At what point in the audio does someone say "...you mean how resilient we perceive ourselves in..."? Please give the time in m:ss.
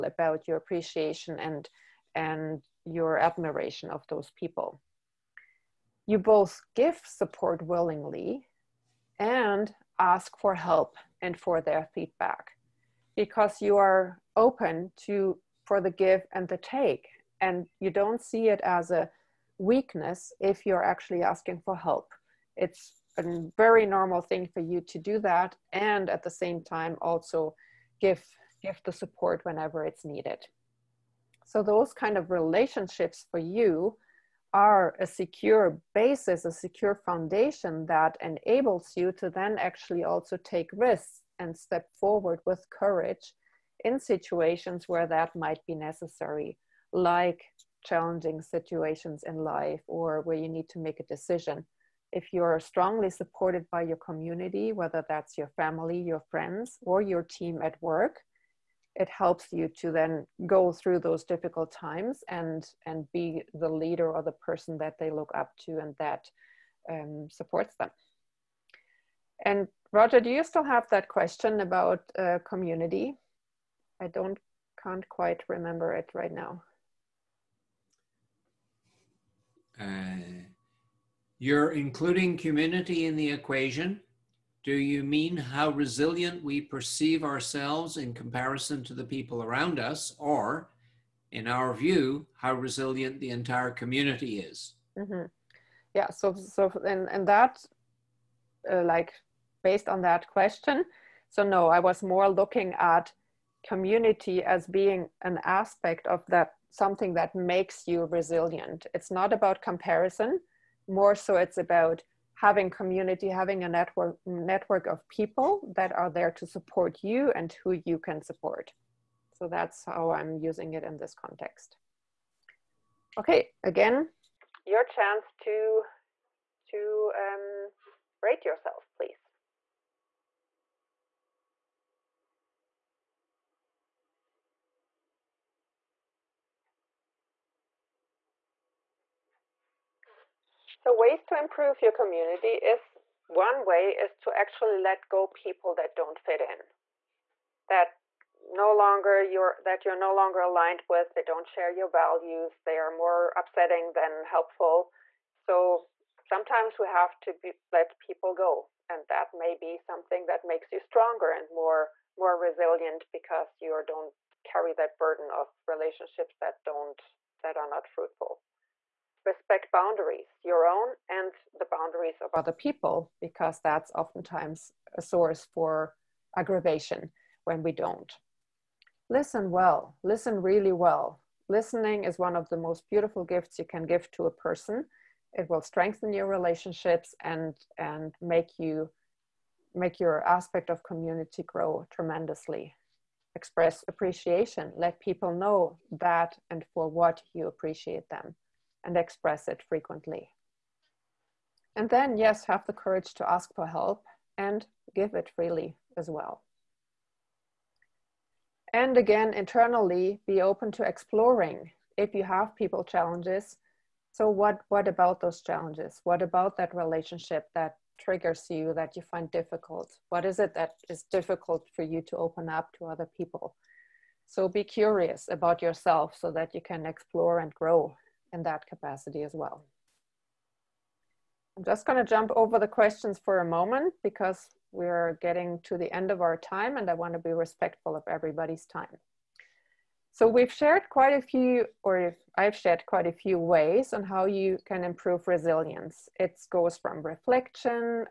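1:24.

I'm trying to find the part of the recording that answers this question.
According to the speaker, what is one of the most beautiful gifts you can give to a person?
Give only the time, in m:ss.
3:01.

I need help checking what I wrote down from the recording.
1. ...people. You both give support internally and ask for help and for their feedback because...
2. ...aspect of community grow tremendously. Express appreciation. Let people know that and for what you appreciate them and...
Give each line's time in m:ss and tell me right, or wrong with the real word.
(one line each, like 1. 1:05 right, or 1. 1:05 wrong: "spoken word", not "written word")
1. 0:04 wrong: "willingly", not "internally"
2. 3:10 right.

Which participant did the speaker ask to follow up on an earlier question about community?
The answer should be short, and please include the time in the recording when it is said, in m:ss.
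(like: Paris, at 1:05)
Roger, at 1:09.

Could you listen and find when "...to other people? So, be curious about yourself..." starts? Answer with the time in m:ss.
3:42.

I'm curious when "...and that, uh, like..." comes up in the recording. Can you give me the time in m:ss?
1:37.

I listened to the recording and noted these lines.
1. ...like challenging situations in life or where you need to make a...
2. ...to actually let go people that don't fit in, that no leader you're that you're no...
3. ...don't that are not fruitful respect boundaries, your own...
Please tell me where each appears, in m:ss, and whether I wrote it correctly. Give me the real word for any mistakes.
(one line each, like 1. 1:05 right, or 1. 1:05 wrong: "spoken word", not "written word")
1. 0:46 right
2. 2:24 wrong: "longer", not "leader"
3. 2:46 right.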